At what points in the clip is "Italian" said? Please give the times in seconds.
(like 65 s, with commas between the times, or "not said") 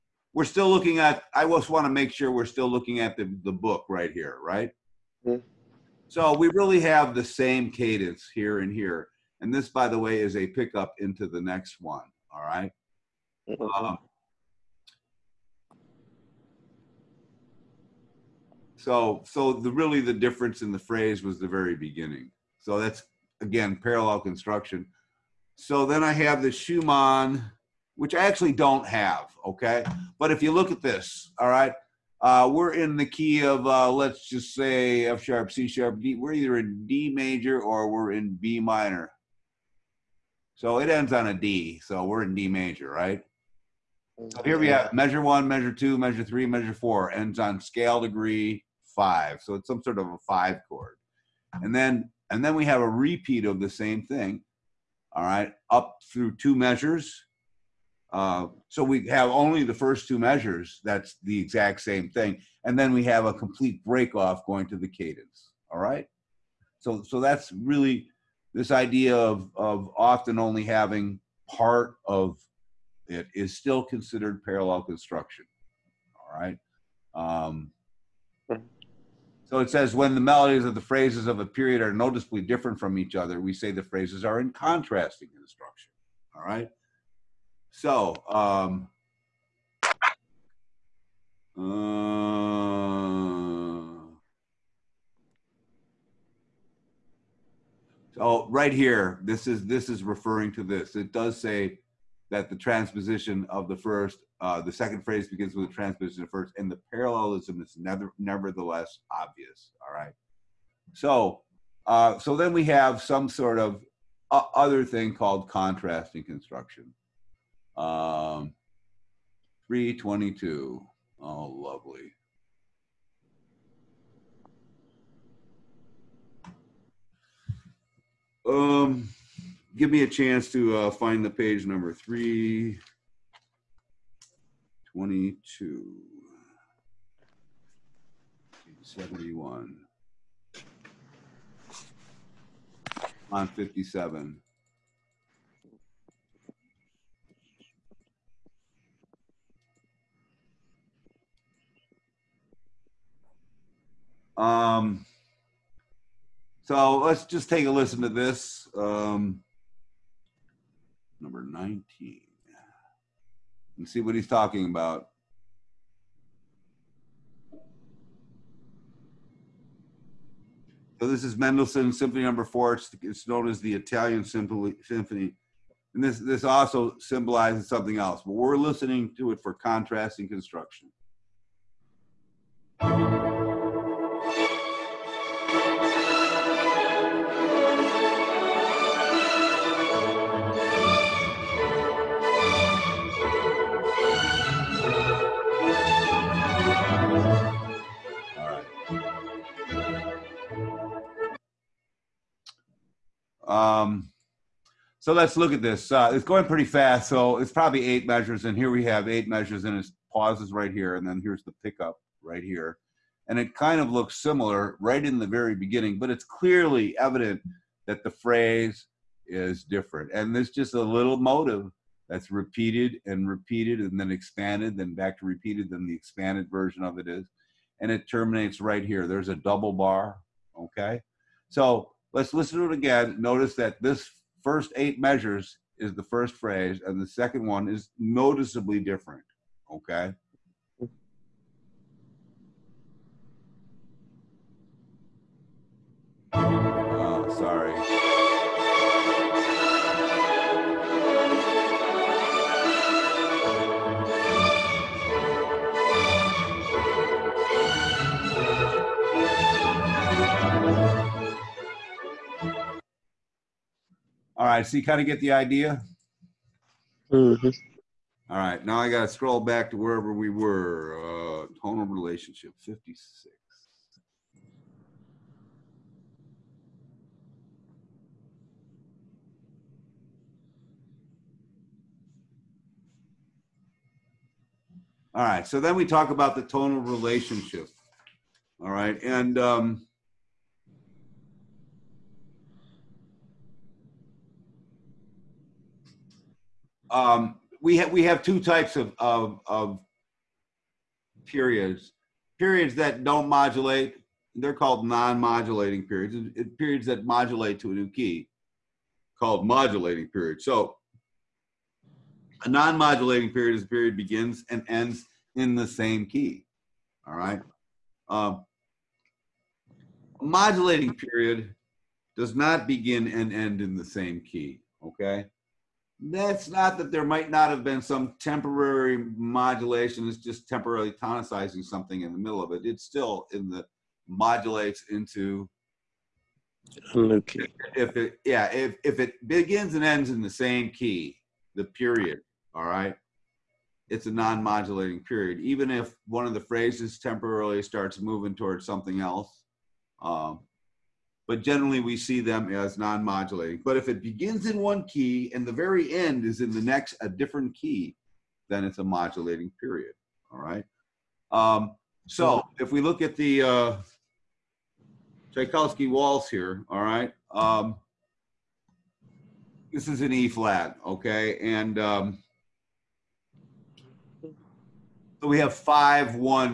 173 s.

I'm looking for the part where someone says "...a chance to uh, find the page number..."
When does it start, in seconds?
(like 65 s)
130 s.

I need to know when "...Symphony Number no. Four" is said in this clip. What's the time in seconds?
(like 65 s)
171 s.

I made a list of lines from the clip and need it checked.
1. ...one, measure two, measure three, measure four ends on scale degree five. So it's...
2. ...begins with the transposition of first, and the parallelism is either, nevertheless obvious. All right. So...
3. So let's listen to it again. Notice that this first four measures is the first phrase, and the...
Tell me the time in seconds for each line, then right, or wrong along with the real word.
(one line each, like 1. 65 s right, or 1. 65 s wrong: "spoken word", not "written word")
1. 45 s right
2. 105 s wrong: "never", not "either"
3. 231 s wrong: "eight", not "four".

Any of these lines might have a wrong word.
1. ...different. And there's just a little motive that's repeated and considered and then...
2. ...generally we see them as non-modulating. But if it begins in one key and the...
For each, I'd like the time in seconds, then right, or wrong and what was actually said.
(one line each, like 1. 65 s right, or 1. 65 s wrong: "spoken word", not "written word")
1. 219 s wrong: "repeated", not "considered"
2. 351 s right.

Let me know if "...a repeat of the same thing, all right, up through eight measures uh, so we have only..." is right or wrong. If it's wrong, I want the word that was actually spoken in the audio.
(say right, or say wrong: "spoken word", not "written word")
wrong: "two", not "eight".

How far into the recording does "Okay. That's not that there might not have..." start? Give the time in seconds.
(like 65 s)
324 s.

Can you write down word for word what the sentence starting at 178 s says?
But we're listening to it for contrast and construction.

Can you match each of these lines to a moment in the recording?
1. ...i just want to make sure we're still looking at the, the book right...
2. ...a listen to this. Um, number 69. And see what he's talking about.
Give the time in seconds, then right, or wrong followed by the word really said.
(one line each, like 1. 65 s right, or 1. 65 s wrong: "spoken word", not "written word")
1. 1 s right
2. 157 s wrong: "19", not "69".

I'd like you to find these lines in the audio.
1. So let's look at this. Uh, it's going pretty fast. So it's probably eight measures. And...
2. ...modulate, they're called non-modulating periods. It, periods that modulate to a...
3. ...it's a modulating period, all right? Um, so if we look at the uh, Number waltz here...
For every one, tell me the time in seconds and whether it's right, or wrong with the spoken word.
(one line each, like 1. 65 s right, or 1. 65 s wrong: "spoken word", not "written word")
1. 205 s right
2. 303 s right
3. 358 s wrong: "Tchaikovsky", not "Number".